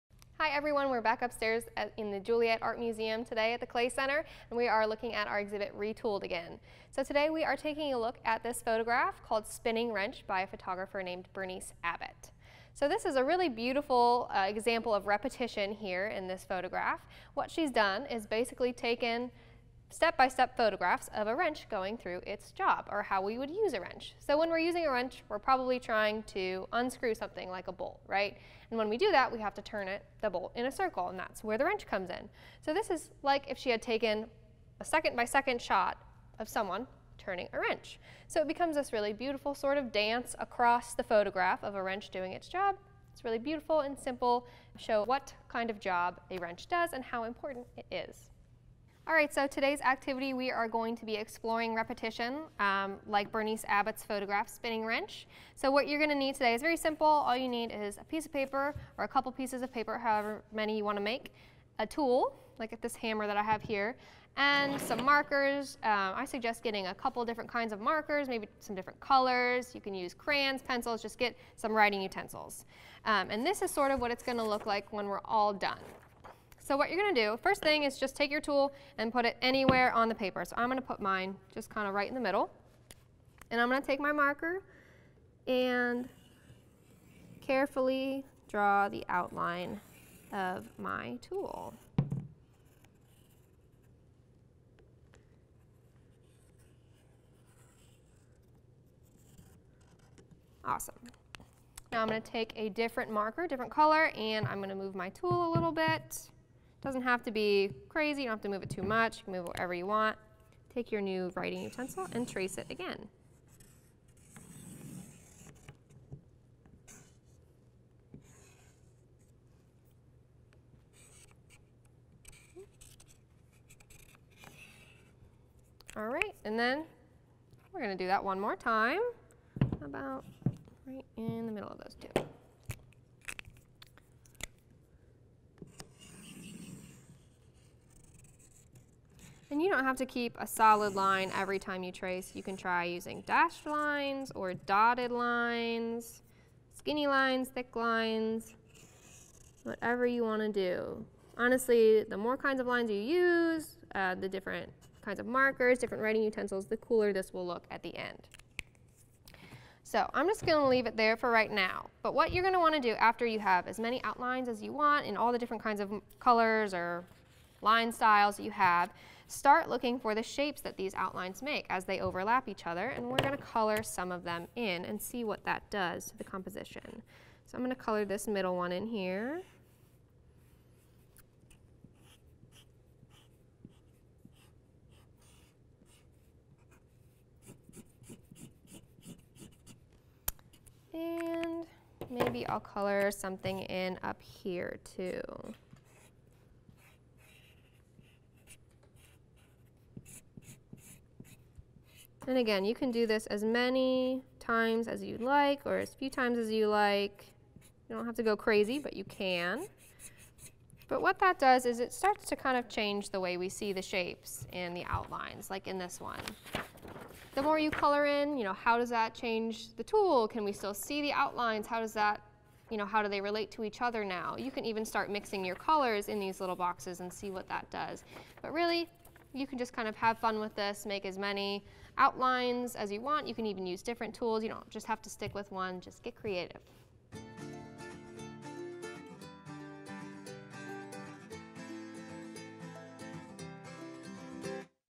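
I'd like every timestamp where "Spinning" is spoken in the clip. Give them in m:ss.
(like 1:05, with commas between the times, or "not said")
0:09, 0:54.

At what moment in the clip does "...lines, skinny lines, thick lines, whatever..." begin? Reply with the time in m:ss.
2:25.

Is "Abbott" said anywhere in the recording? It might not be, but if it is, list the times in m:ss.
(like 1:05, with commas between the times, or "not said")
0:11, 0:53.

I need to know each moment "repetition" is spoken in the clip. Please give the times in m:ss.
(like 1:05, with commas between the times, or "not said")
0:15, 0:51.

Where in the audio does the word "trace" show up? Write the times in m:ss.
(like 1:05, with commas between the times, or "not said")
1:52, 2:21.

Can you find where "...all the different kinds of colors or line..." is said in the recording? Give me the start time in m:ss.
2:45.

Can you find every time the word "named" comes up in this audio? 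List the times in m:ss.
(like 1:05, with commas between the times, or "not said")
0:11.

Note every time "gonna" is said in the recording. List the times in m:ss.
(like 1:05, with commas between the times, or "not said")
0:55, 1:14, 2:07.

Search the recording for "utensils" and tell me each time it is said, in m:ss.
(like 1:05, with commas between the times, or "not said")
1:12, 1:51, 2:36.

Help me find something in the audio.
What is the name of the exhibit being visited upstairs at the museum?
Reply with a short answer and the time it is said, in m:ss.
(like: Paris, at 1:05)
Retooled, at 0:05.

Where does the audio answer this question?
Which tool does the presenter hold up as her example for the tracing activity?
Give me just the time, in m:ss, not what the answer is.
1:02.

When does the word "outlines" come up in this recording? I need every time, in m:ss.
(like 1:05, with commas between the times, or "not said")
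1:29, 2:44, 2:50, 3:34, 3:41, 3:51.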